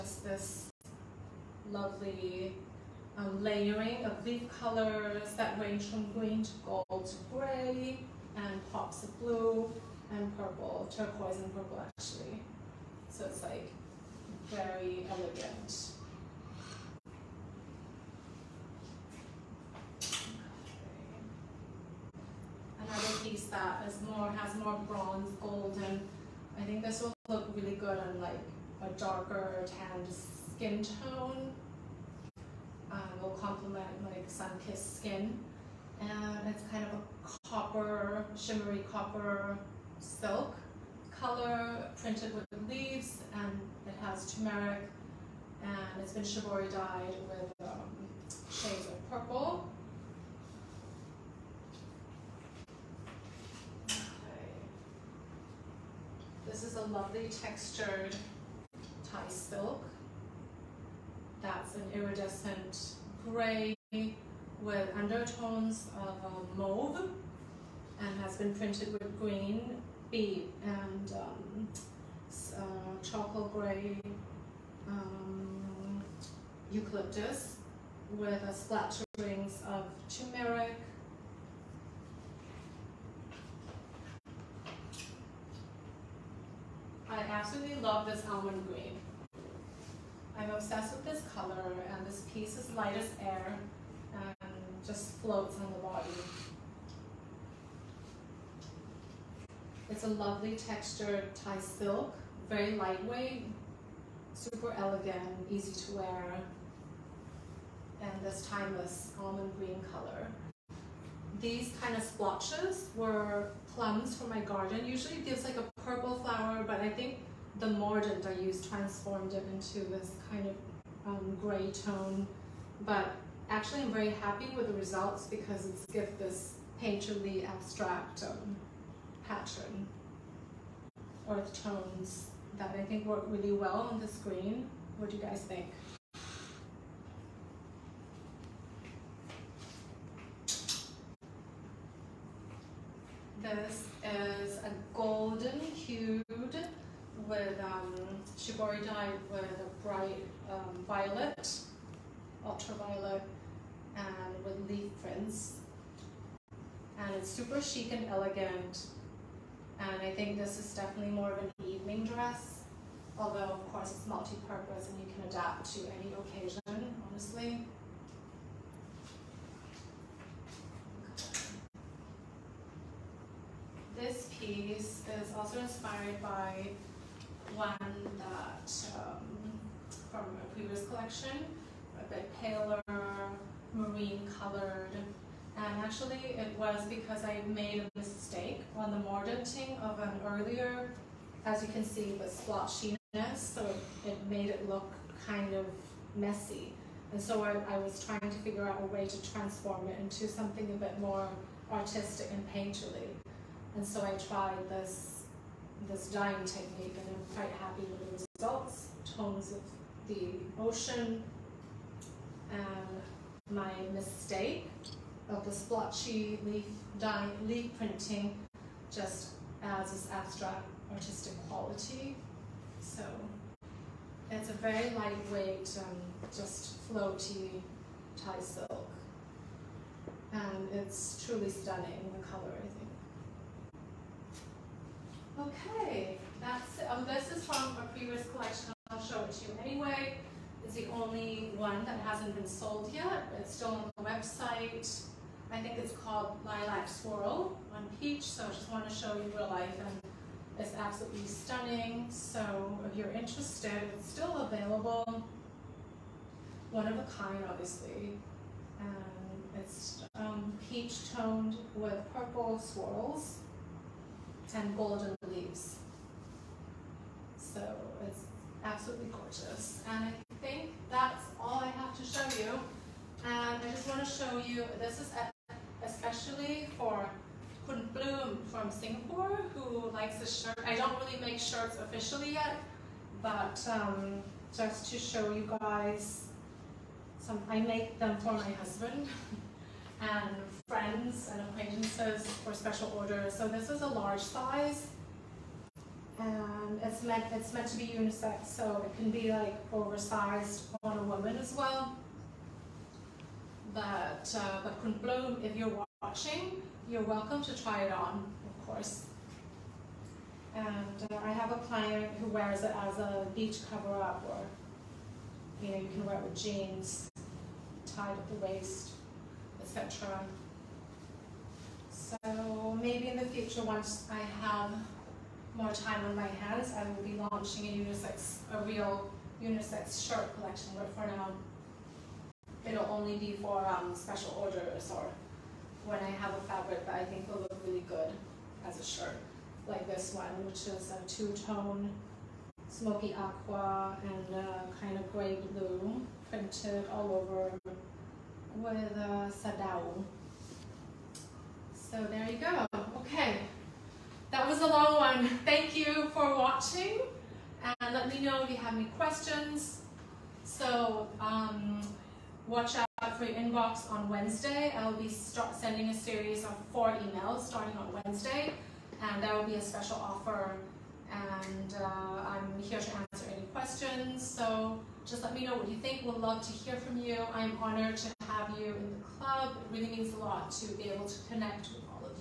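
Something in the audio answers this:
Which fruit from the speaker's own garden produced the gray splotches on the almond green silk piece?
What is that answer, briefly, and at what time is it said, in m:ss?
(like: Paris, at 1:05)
Plums, at 1:53.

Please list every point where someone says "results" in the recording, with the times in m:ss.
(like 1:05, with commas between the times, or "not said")
2:04, 3:28.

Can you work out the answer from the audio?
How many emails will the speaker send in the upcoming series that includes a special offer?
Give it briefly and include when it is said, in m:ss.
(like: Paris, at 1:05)
4, at 6:06.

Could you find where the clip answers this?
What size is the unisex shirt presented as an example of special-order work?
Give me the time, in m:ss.
4:53.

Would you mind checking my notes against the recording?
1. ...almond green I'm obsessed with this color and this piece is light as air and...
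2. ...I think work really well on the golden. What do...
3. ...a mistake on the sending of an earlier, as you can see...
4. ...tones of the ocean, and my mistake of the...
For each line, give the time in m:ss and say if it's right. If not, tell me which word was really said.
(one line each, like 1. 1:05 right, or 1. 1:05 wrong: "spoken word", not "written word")
1. 1:28 right
2. 2:12 wrong: "screen", not "golden"
3. 3:07 wrong: "mordanting", not "sending"
4. 3:29 right.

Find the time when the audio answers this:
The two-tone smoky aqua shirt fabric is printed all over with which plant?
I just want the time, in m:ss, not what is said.
5:49.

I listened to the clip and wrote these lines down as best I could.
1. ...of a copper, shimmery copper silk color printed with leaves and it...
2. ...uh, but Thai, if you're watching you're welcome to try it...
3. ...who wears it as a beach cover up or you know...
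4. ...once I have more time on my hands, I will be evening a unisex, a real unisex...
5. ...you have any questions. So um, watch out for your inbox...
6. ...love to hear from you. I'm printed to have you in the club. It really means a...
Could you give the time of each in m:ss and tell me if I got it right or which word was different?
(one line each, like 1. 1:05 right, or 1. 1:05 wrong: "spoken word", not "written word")
1. 0:36 right
2. 5:04 wrong: "Kunplum", not "Thai"
3. 5:12 right
4. 5:23 wrong: "launching", not "evening"
5. 5:58 right
6. 6:16 wrong: "honored", not "printed".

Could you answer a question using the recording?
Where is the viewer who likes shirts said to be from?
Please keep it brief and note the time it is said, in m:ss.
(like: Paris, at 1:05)
Singapore, at 4:38.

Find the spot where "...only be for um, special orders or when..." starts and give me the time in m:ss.
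5:32.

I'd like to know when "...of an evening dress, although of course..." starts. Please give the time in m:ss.
2:41.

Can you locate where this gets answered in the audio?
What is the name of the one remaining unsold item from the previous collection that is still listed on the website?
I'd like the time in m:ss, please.
4:06.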